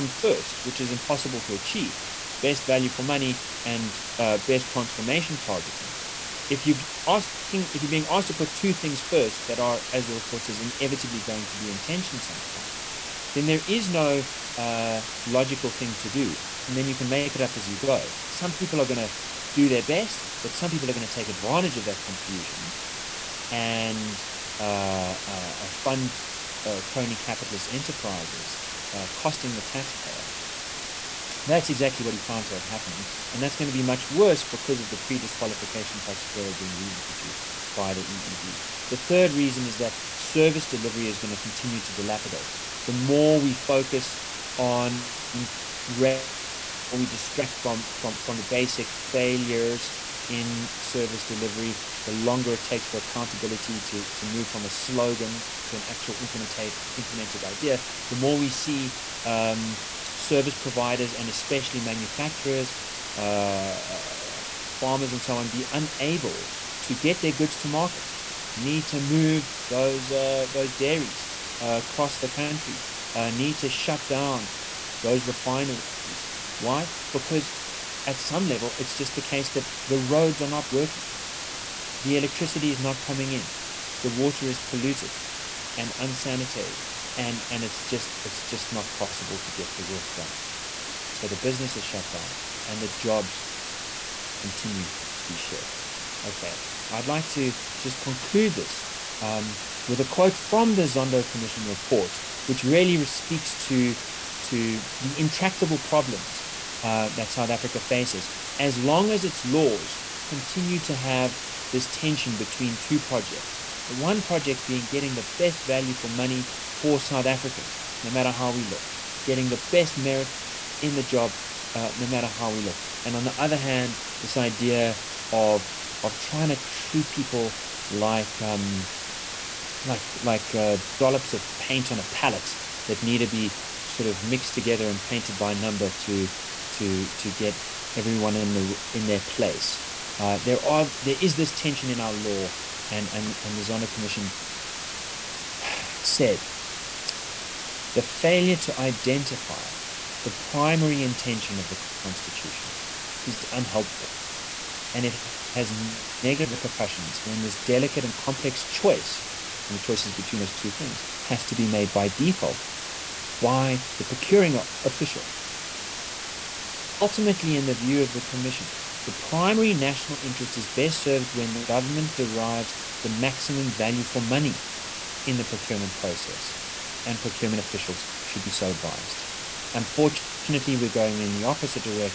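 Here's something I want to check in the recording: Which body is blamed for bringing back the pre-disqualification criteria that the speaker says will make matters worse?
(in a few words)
EEB.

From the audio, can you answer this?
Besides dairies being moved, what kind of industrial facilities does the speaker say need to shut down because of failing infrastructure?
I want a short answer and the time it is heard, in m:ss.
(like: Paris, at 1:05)
Refineries, at 1:15.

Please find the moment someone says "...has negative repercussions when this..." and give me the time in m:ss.
2:35.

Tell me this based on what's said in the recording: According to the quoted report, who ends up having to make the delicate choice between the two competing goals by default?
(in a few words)
The procuring official.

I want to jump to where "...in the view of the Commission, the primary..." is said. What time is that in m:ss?
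2:47.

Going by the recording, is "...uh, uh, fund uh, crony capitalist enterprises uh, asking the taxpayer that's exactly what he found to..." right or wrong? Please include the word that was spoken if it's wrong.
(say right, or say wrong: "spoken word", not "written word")
wrong: "costing", not "asking".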